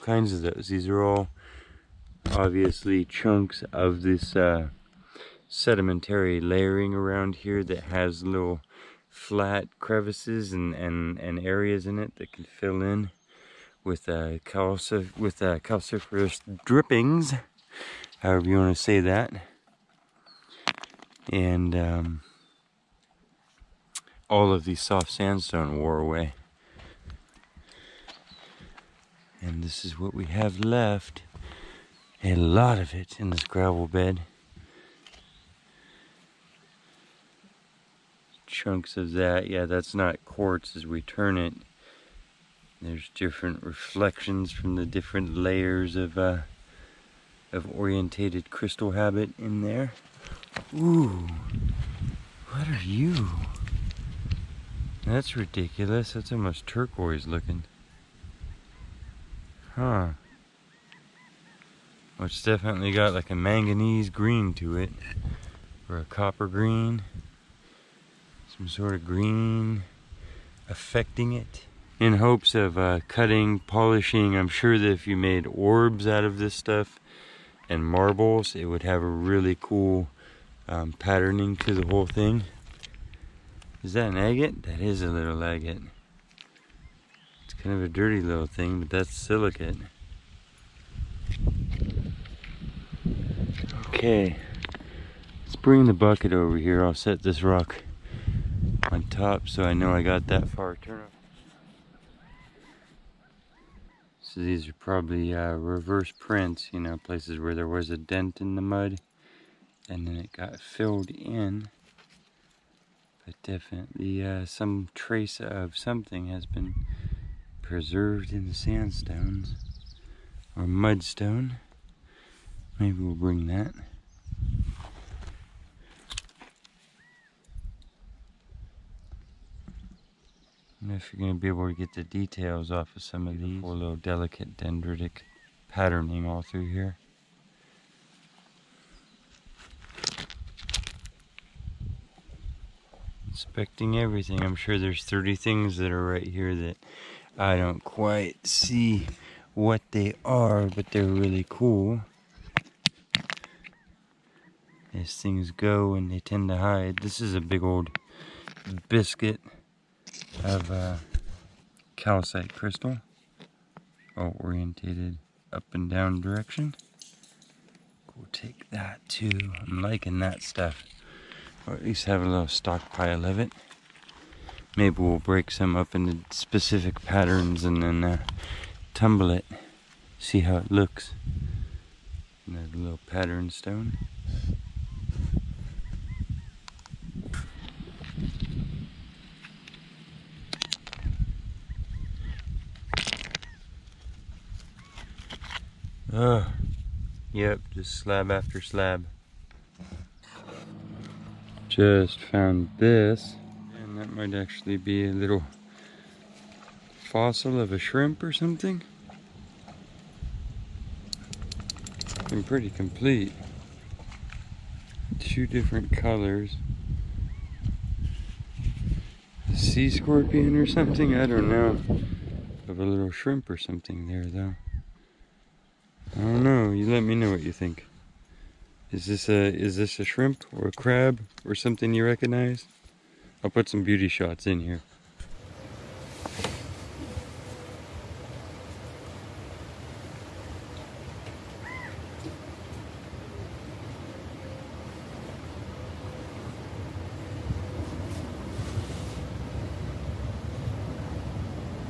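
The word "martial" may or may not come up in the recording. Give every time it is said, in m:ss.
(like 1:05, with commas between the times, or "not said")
not said.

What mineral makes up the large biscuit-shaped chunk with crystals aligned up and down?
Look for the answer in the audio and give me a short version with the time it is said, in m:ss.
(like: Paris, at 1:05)
Calcite, at 2:41.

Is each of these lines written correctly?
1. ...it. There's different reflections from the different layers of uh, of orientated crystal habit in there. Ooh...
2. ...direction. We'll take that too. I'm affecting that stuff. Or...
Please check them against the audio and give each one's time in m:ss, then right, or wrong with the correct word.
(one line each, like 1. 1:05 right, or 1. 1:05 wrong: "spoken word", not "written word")
1. 0:41 right
2. 2:46 wrong: "liking", not "affecting".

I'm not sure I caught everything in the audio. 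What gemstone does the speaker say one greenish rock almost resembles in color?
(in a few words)
Turquoise.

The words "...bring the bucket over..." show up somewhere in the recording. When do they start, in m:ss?
1:35.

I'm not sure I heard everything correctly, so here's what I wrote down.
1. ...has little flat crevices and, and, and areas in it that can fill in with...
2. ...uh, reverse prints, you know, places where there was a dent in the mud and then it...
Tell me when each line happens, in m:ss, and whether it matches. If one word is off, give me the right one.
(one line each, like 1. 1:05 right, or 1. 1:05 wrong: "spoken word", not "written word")
1. 0:07 right
2. 1:45 right.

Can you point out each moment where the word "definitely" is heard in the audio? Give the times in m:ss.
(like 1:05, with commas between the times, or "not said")
1:02, 1:53.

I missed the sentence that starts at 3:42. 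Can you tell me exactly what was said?
Of a little shrimp or something there though.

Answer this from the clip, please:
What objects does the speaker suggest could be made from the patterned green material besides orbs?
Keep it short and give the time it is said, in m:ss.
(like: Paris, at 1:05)
Marbles, at 1:17.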